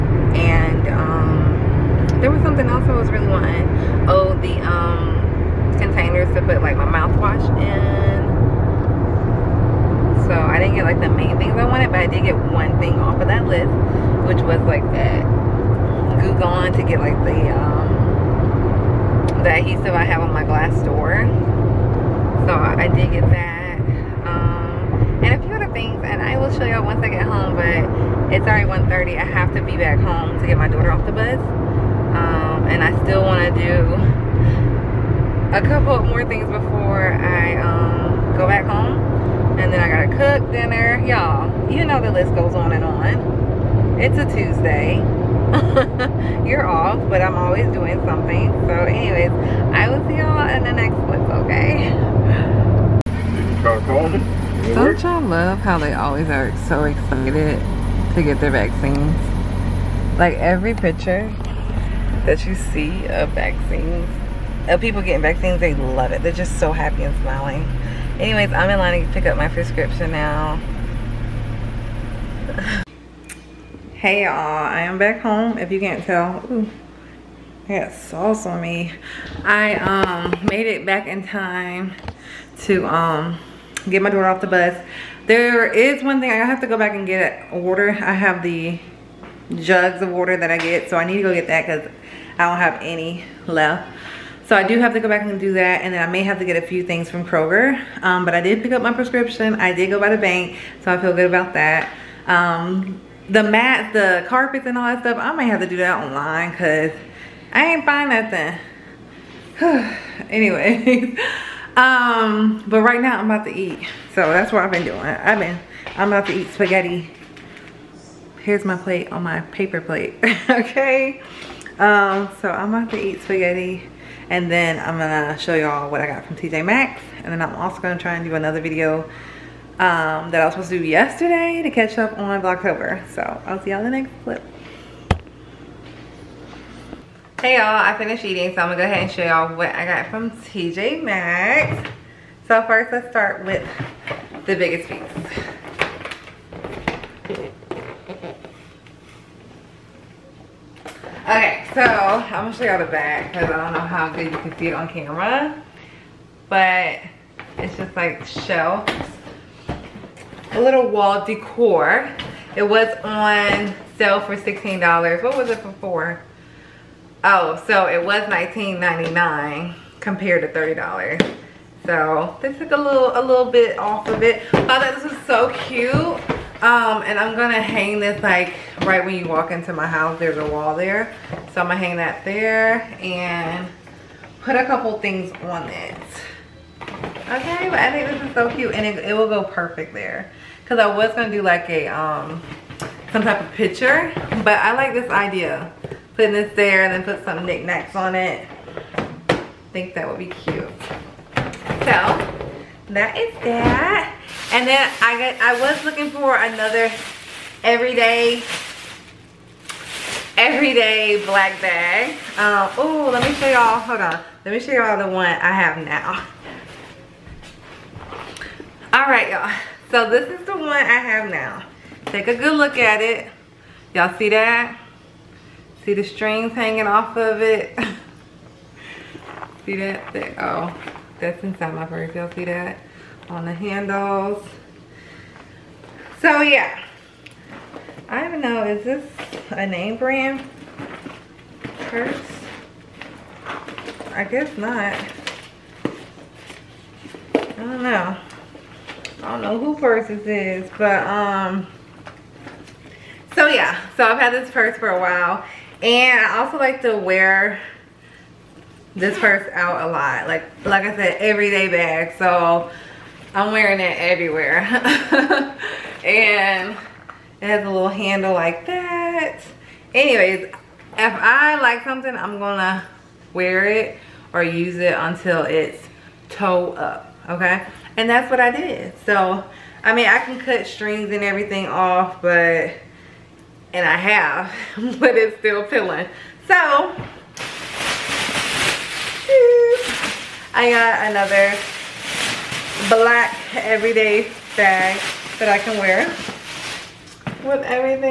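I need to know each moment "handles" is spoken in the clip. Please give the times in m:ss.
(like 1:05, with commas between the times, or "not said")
3:53, 4:27.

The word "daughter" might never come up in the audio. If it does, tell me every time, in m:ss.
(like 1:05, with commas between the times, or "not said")
0:30, 1:24.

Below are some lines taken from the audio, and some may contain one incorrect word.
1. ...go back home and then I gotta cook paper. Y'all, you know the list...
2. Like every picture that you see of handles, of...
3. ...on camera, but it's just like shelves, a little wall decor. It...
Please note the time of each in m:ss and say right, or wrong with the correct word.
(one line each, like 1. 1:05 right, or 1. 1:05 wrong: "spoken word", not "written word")
1. 0:38 wrong: "dinner", not "paper"
2. 1:00 wrong: "vaccines", not "handles"
3. 2:34 right.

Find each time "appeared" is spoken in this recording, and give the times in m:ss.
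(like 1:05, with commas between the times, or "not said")
not said.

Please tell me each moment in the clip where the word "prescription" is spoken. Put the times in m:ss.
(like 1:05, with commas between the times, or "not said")
1:09, 1:38.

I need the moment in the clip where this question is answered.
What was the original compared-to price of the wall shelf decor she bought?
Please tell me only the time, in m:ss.
2:50.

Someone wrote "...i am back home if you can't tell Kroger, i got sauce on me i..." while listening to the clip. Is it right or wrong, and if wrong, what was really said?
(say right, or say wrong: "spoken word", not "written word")
wrong: "Ooh", not "Kroger".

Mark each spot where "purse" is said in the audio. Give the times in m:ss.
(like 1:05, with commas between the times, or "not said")
3:51, 4:01, 4:09, 4:14, 4:19.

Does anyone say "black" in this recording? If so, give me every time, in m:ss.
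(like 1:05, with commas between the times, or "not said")
3:31, 4:52.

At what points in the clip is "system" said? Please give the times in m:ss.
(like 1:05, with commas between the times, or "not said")
not said.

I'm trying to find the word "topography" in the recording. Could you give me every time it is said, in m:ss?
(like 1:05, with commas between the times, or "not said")
not said.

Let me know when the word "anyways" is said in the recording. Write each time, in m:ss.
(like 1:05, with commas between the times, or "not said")
0:48, 1:08, 1:50, 4:29.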